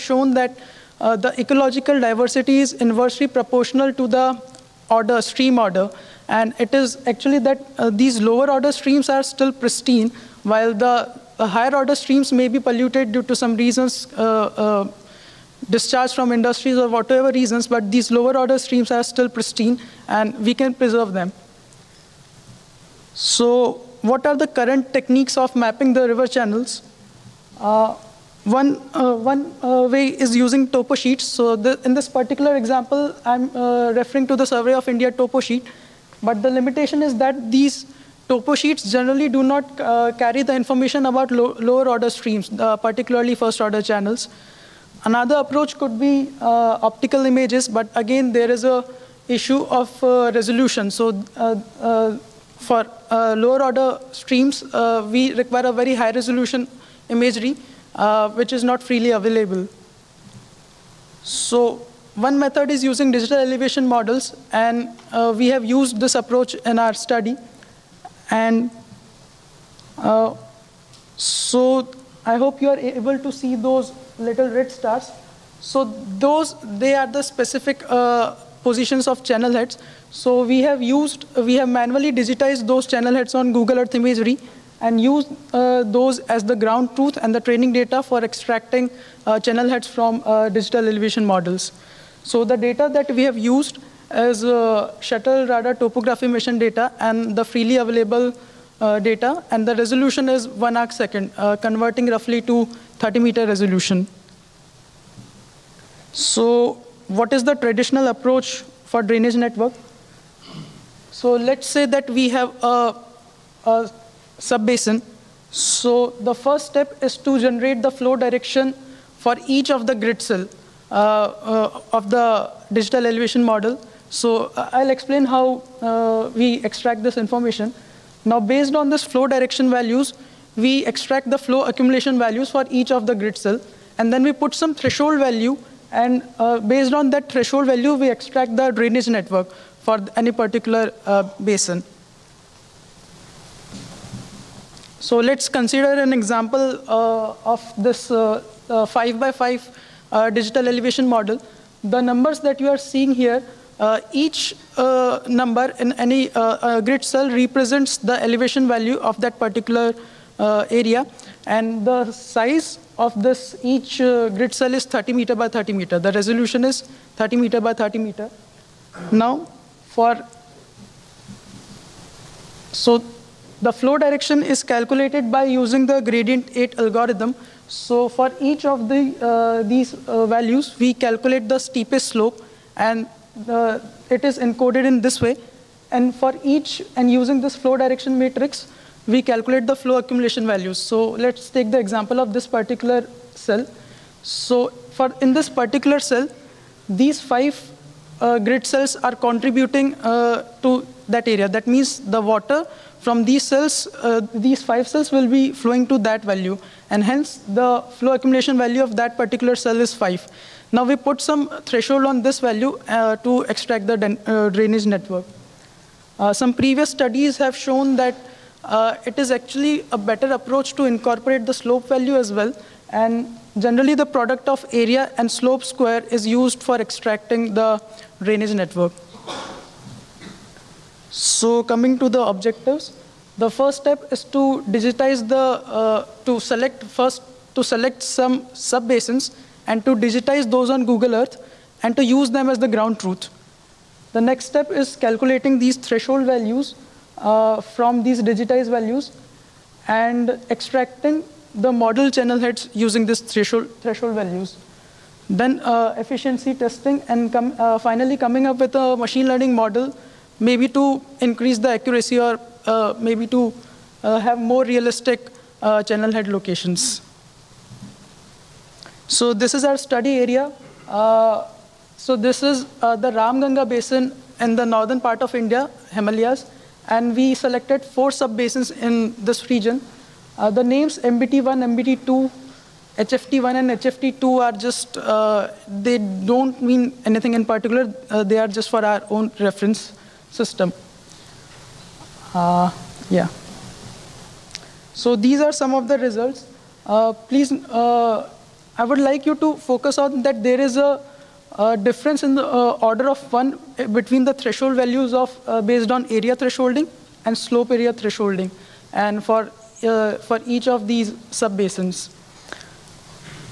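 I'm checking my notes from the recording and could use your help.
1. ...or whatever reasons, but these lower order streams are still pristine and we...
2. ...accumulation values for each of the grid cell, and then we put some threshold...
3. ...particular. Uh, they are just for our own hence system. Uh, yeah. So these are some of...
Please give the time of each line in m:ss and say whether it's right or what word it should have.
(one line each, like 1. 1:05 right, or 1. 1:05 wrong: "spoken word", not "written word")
1. 0:16 right
2. 2:11 right
3. 4:47 wrong: "reference", not "hence".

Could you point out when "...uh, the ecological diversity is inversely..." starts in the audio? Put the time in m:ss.
0:01.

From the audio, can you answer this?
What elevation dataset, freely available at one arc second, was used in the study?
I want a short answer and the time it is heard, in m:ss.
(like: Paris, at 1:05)
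Shuttle Radar Topography Mission, at 1:35.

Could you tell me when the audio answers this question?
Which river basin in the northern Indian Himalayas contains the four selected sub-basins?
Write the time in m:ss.
4:33.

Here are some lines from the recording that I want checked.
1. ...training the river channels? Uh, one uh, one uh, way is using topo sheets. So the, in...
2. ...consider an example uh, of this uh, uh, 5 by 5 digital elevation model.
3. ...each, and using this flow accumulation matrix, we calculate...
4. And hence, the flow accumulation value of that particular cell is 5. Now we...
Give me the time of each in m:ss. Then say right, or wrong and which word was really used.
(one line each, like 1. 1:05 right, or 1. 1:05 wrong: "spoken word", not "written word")
1. 0:25 wrong: "mapping", not "training"
2. 2:25 right
3. 3:06 wrong: "direction", not "accumulation"
4. 3:26 right.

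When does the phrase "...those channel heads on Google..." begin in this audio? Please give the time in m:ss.
1:22.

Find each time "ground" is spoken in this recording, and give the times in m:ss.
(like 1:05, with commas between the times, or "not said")
1:26, 4:02.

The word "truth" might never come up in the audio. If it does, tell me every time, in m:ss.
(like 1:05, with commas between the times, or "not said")
1:26, 4:02.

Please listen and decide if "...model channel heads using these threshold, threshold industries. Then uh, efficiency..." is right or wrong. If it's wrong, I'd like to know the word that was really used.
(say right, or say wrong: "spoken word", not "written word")
wrong: "values", not "industries".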